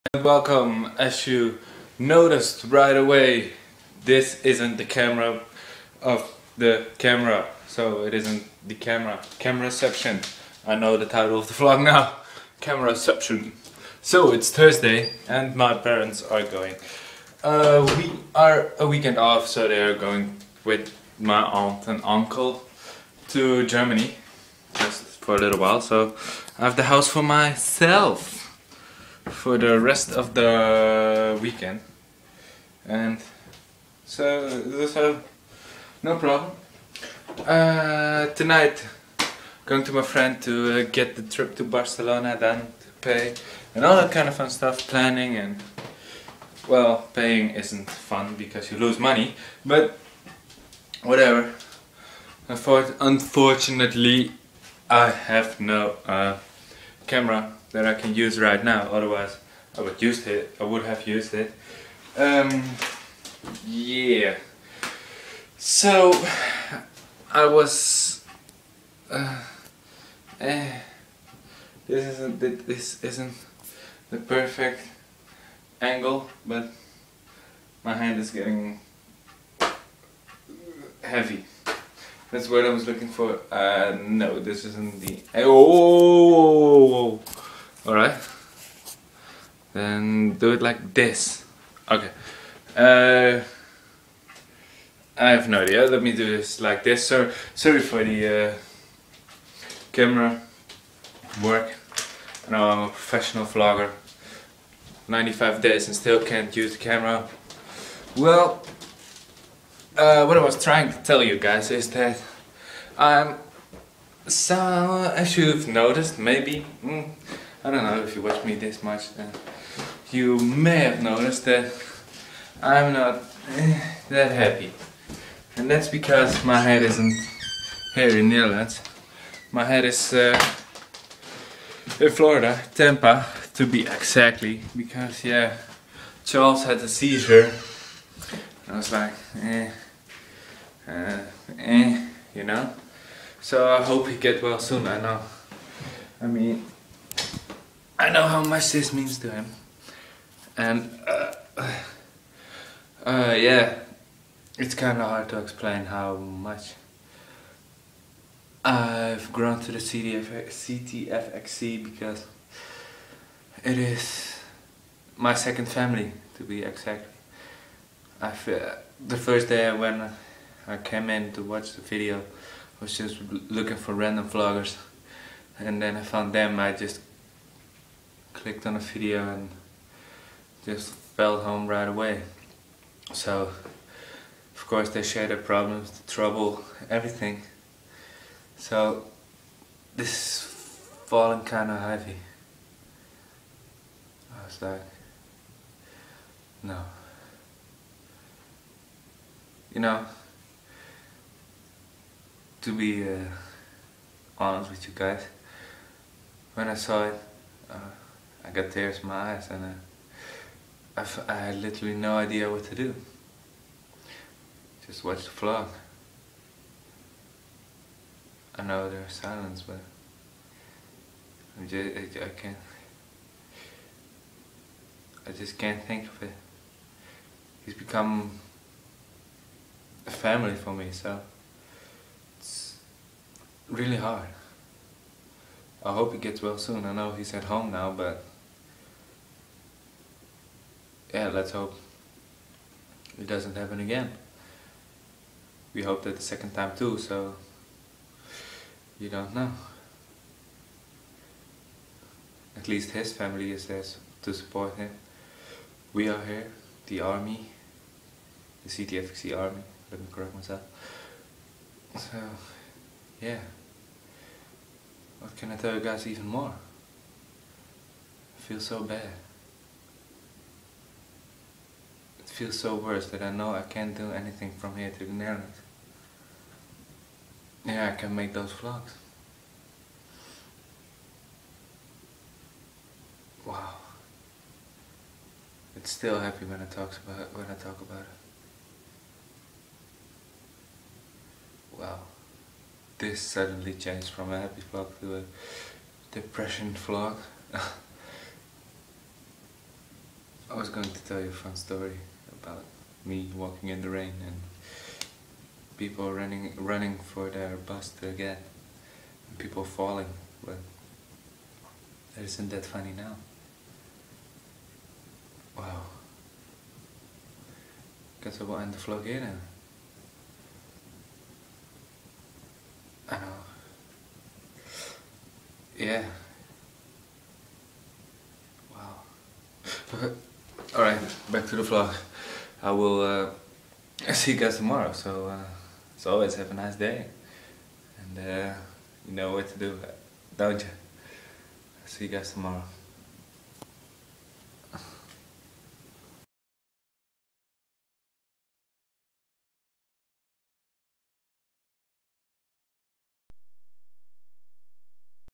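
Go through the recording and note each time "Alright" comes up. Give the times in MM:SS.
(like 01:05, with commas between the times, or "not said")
01:27, 05:30.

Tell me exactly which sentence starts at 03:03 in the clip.
So, of course, they share their problems, the trouble, everything.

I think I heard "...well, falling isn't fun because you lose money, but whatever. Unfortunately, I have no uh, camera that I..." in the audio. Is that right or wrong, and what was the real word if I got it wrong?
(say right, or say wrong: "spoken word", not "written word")
wrong: "paying", not "falling".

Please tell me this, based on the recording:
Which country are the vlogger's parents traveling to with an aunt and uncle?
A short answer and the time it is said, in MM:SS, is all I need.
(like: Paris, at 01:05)
Germany, at 00:23.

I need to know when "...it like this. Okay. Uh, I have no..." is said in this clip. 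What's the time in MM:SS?
01:30.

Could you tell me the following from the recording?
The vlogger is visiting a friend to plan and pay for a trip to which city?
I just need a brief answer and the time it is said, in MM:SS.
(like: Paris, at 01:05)
Barcelona, at 00:41.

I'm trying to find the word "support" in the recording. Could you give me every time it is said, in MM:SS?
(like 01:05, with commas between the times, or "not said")
04:14.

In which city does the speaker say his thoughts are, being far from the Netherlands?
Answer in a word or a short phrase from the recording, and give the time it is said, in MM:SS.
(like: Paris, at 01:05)
Tampa, at 02:12.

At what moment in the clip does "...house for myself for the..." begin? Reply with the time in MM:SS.
00:26.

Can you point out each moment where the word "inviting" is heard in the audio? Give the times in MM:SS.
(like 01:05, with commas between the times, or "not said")
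not said.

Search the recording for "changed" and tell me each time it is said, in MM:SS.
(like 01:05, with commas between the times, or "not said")
04:53.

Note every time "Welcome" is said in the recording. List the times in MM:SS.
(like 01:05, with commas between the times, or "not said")
00:00.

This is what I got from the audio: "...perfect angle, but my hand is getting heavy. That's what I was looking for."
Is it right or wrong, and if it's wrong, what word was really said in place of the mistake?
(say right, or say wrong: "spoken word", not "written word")
right.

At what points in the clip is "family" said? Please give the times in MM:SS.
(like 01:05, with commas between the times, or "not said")
02:45, 03:50, 04:13.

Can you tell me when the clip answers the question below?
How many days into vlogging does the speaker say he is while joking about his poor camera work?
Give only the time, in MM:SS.
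01:45.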